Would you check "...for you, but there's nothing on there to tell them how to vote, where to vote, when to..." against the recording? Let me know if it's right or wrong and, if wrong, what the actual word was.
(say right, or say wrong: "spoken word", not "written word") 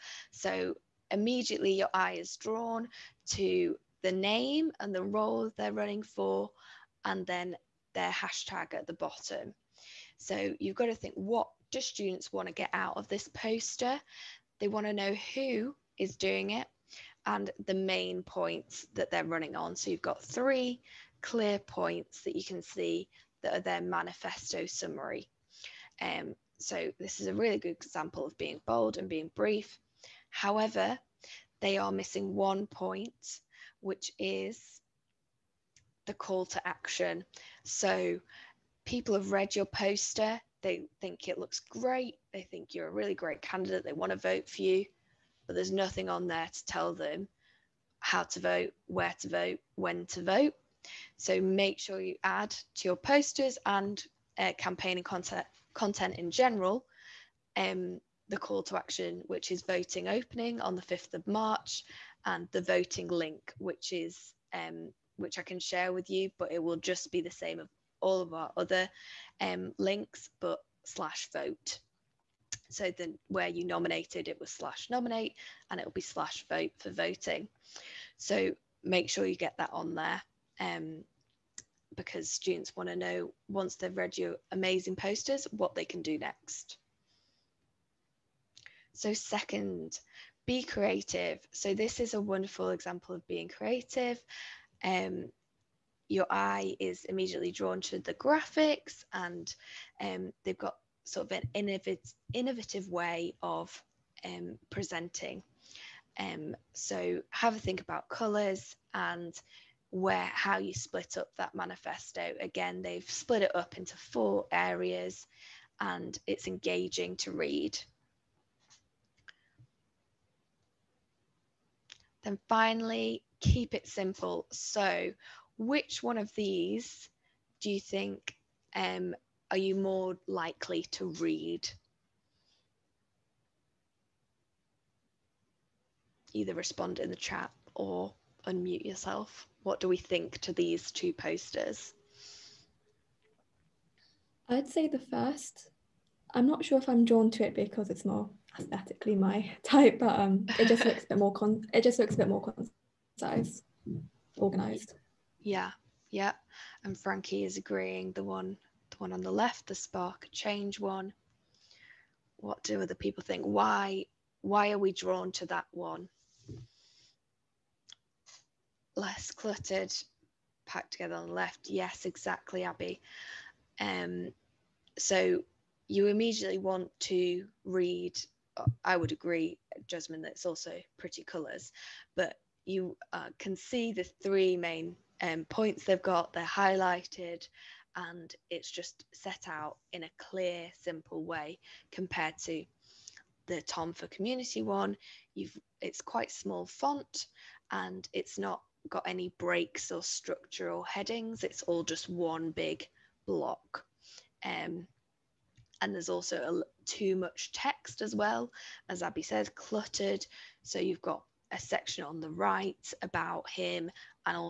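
right.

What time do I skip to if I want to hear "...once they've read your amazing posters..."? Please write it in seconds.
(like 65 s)
83 s.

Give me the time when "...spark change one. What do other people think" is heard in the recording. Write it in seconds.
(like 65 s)
159 s.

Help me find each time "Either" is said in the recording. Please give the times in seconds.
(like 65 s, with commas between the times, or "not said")
136 s.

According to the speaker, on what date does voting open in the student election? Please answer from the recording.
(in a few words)
5th of March.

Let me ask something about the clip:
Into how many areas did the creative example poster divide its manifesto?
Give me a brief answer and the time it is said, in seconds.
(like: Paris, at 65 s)
4, at 113 s.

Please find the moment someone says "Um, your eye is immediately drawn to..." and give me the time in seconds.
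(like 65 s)
94 s.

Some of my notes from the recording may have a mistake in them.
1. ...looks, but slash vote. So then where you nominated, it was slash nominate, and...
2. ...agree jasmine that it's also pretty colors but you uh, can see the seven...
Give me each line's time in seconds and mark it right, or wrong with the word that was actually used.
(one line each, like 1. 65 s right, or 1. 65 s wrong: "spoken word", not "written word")
1. 69 s wrong: "links", not "looks"
2. 179 s wrong: "three", not "seven".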